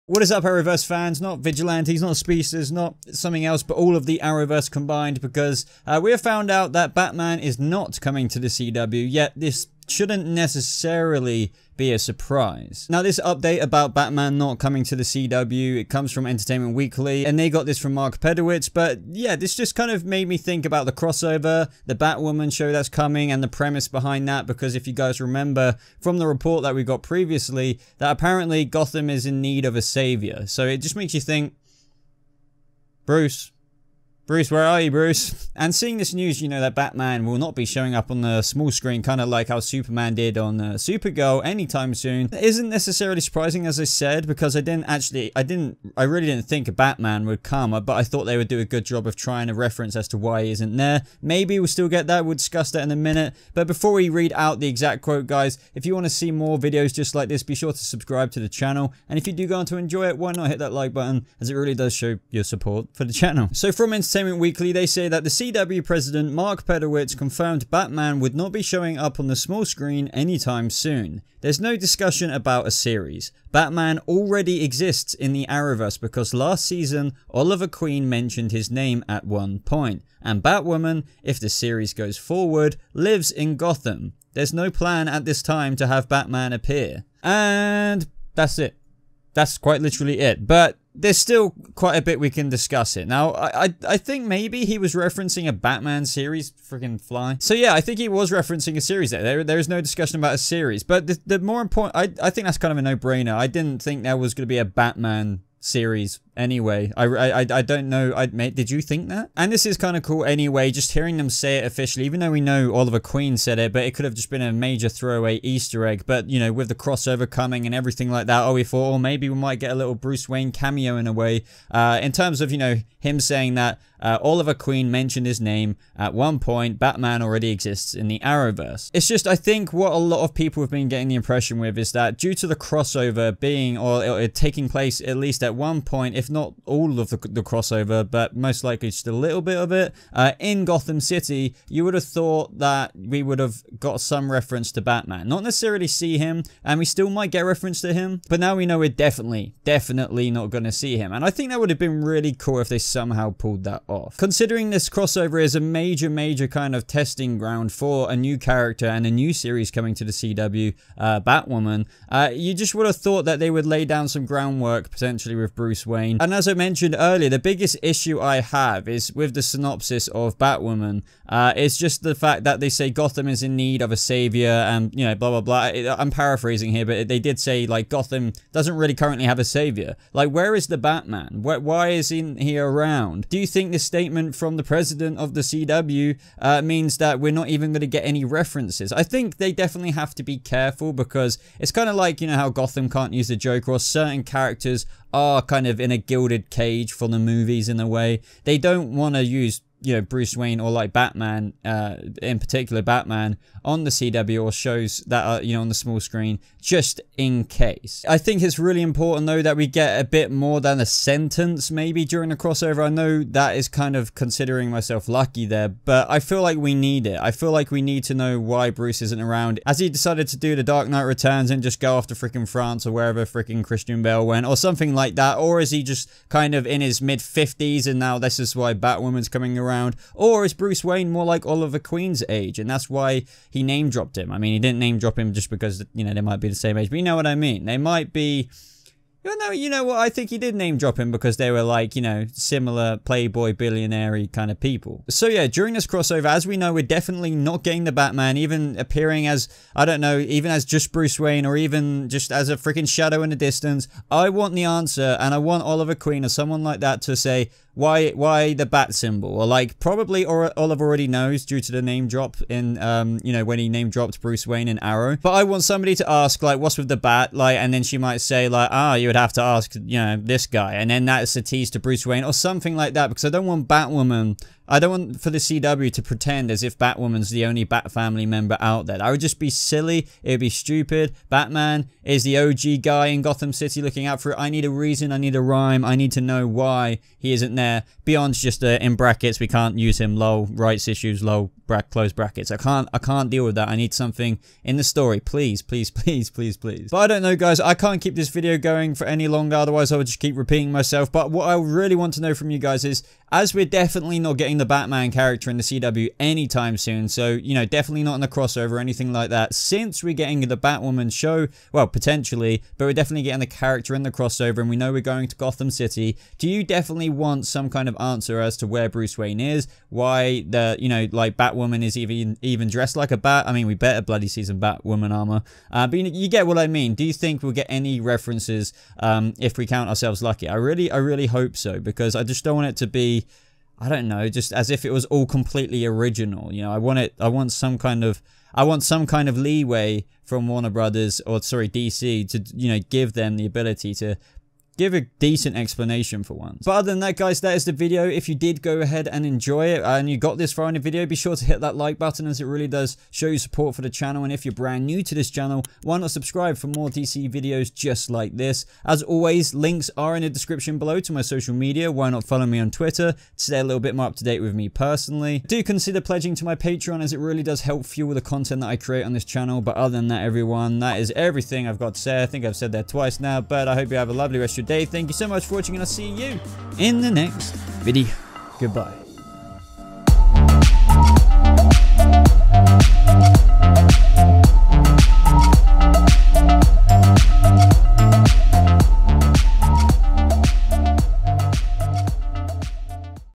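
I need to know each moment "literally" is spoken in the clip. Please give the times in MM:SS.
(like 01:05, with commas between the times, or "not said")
01:29.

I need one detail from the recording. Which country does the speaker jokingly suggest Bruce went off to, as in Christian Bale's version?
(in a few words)
France.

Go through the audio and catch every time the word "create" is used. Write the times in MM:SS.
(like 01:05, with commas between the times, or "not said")
06:08.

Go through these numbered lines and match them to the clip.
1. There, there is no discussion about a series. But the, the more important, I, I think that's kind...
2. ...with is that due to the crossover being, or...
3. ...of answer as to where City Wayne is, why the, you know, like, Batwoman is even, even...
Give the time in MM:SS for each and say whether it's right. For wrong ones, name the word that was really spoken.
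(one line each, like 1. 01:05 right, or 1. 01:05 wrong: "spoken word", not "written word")
1. 01:39 right
2. 02:11 right
3. 05:17 wrong: "Bruce", not "City".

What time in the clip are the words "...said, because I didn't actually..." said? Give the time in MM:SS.
00:43.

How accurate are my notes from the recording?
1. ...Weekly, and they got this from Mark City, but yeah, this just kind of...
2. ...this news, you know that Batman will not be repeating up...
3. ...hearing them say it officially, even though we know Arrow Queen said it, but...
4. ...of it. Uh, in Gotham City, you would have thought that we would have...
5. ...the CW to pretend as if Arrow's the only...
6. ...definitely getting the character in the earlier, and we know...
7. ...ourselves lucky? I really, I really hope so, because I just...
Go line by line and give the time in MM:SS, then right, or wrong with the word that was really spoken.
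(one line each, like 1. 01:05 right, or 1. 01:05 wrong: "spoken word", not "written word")
1. 00:16 wrong: "Pedowitz", not "City"
2. 00:35 wrong: "showing", not "repeating"
3. 01:50 wrong: "Oliver", not "Arrow"
4. 02:19 right
5. 04:35 wrong: "Batwoman", not "Arrow"
6. 05:12 wrong: "crossover", not "earlier"
7. 05:29 right.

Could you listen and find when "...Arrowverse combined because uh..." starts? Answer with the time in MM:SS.
00:04.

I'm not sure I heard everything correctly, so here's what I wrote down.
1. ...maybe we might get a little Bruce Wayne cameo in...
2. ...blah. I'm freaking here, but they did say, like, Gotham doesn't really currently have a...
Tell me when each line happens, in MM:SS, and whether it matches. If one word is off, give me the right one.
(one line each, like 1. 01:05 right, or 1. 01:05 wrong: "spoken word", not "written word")
1. 01:58 right
2. 02:55 wrong: "paraphrasing", not "freaking".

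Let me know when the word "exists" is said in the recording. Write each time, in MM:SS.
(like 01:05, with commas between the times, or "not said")
01:14, 02:07.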